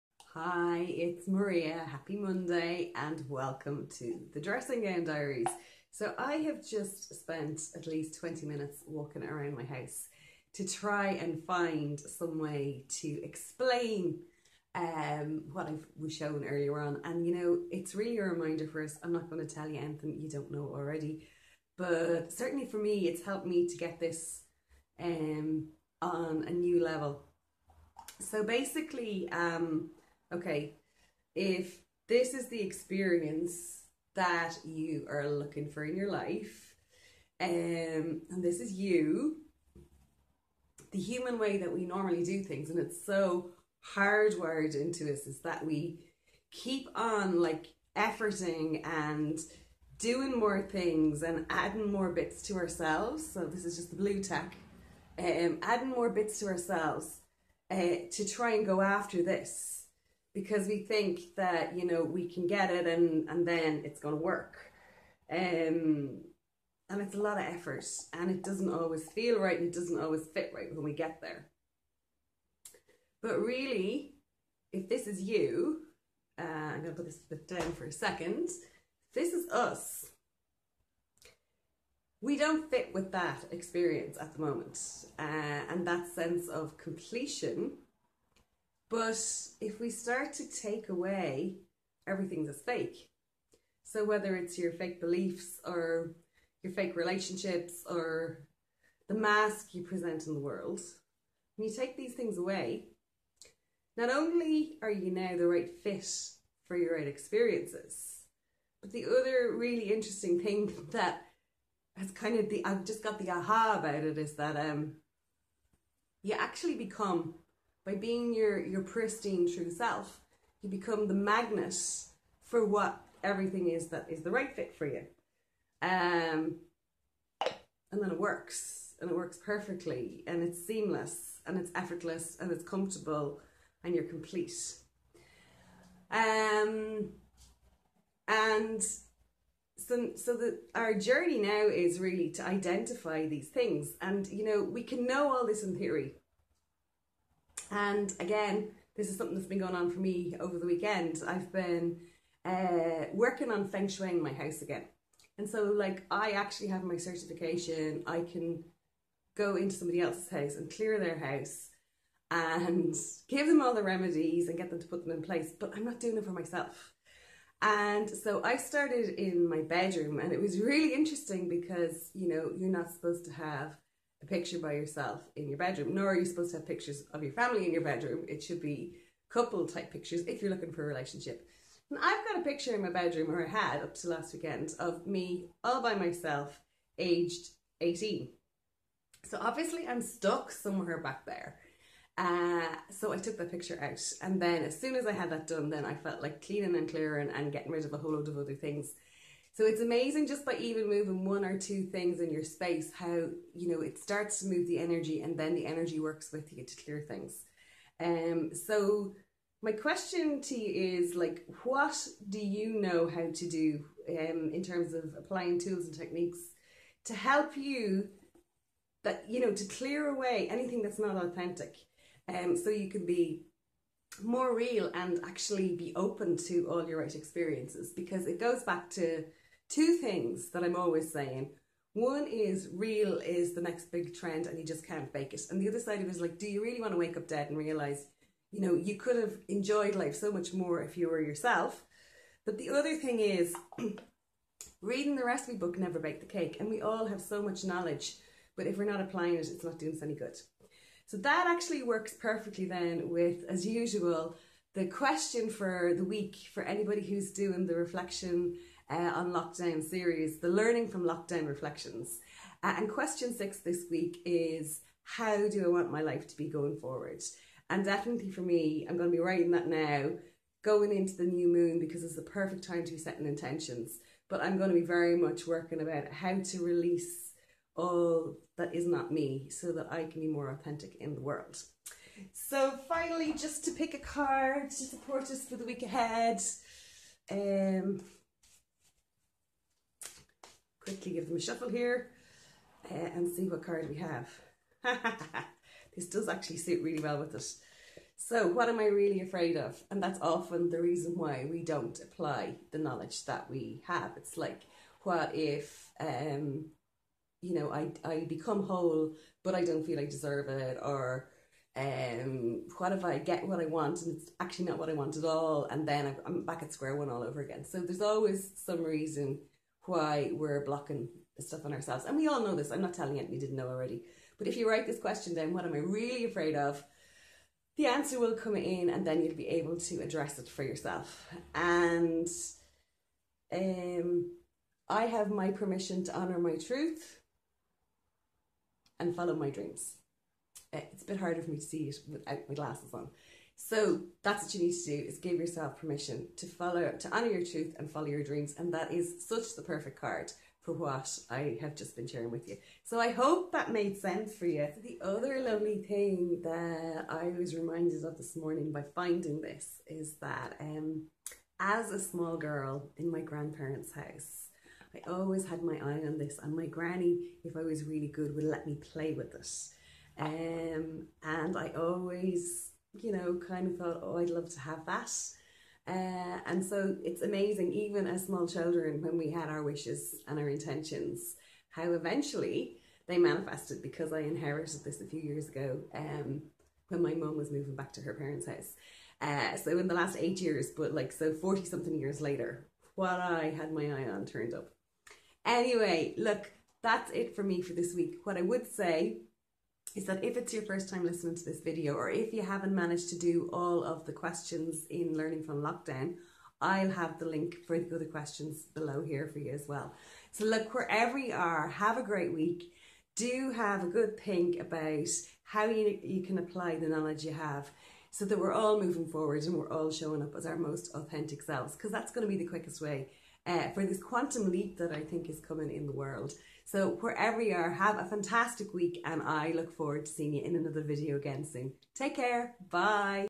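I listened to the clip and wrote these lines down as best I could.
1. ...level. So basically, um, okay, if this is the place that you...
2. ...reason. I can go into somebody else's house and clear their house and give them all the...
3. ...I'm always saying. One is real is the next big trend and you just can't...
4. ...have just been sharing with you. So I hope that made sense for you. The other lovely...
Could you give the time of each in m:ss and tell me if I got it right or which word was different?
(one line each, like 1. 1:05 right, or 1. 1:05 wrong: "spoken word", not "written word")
1. 0:26 wrong: "experience", not "place"
2. 2:36 wrong: "certification", not "reason"
3. 3:50 right
4. 5:51 right.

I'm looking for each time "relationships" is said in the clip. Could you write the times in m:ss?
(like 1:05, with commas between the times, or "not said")
1:36, 3:00.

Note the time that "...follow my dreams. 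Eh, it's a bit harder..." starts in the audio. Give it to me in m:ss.
5:39.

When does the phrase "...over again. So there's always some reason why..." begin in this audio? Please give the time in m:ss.
5:17.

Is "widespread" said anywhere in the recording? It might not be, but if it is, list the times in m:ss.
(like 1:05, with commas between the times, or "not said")
not said.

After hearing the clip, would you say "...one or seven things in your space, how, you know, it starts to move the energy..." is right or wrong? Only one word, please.
wrong.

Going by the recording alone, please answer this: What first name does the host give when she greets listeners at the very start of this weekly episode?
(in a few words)
Maria.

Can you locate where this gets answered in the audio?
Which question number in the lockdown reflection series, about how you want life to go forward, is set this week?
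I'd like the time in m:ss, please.
4:22.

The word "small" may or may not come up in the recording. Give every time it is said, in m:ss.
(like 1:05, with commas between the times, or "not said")
6:01, 6:18.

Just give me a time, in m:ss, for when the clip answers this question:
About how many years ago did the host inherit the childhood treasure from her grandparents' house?
6:30.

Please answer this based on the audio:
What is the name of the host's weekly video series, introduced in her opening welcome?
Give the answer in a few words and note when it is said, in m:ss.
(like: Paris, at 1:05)
Dressing Gown Diaries, at 0:04.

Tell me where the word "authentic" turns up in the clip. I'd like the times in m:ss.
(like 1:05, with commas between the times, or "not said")
3:41, 4:40, 7:00.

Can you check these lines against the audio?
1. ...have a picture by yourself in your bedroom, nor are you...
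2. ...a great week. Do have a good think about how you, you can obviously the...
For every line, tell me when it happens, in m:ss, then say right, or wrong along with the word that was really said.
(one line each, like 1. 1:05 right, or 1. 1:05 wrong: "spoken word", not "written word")
1. 2:53 right
2. 6:51 wrong: "apply", not "obviously".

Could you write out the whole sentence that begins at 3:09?
So obviously I'm stuck somewhere back there.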